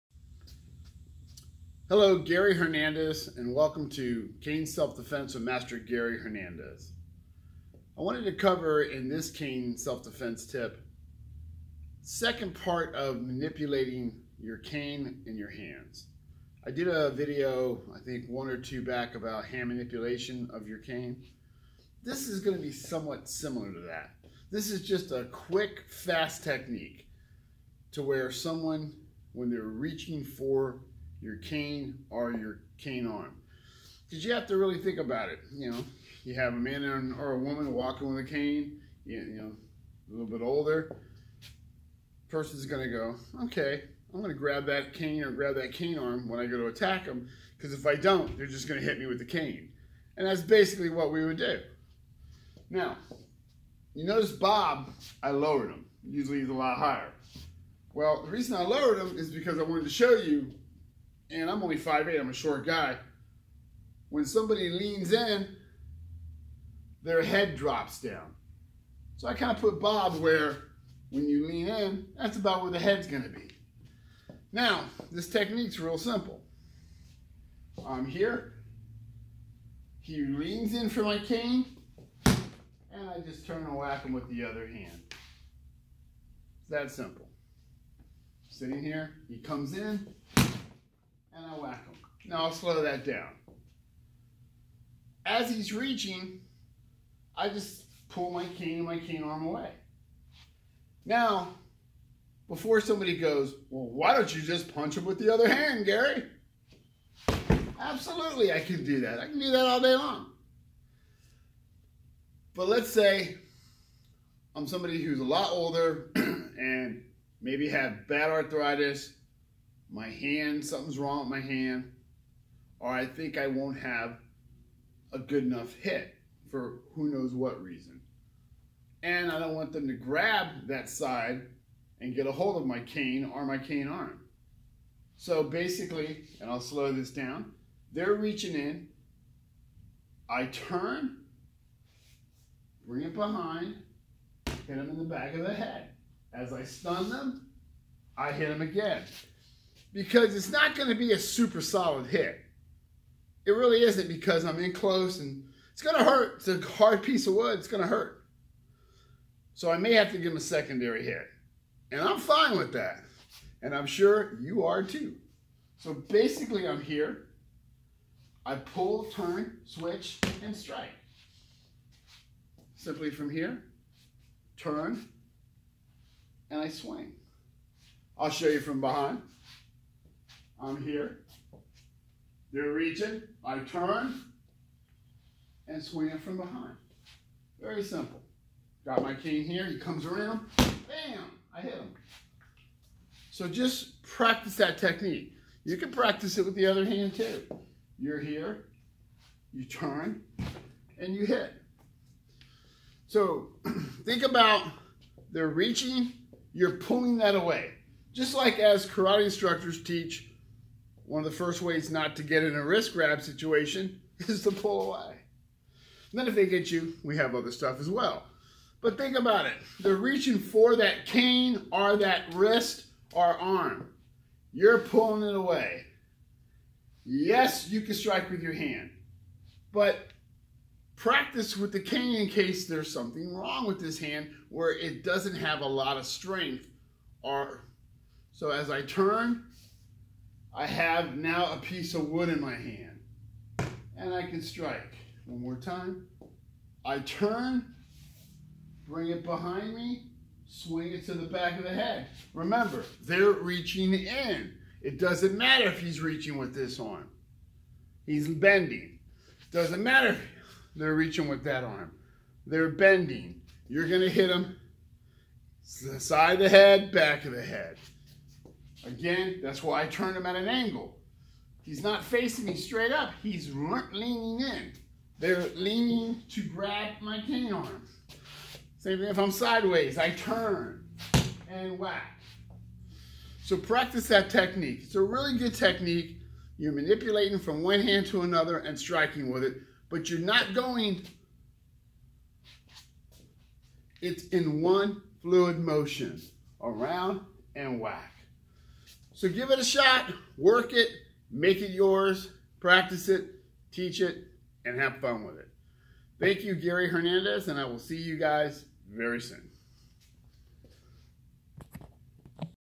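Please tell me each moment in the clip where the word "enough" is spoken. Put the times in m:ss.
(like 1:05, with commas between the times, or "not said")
2:05.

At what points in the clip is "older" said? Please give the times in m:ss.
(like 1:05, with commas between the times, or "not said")
0:40, 1:55.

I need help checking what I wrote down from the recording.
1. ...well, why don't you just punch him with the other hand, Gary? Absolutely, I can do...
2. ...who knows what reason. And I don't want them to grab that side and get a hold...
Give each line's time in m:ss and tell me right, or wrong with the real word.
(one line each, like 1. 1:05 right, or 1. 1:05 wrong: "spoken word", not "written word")
1. 1:43 right
2. 2:06 right.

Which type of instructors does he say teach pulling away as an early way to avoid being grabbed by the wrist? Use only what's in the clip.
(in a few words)
Karate instructors.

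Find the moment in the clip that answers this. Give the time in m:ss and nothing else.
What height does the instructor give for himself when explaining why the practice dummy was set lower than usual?
1:01.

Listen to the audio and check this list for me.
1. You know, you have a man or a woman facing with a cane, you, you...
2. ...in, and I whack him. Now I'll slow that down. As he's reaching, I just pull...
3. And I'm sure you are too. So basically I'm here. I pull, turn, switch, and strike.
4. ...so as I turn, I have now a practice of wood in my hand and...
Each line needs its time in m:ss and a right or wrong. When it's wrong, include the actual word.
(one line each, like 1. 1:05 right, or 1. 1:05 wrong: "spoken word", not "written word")
1. 0:35 wrong: "walking", not "facing"
2. 1:29 right
3. 2:43 right
4. 3:58 wrong: "piece", not "practice".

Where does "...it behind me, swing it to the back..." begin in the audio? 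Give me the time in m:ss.
4:09.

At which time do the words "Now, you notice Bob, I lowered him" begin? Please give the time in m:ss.
0:52.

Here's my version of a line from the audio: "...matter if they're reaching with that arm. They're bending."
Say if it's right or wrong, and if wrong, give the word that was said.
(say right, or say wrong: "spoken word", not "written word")
right.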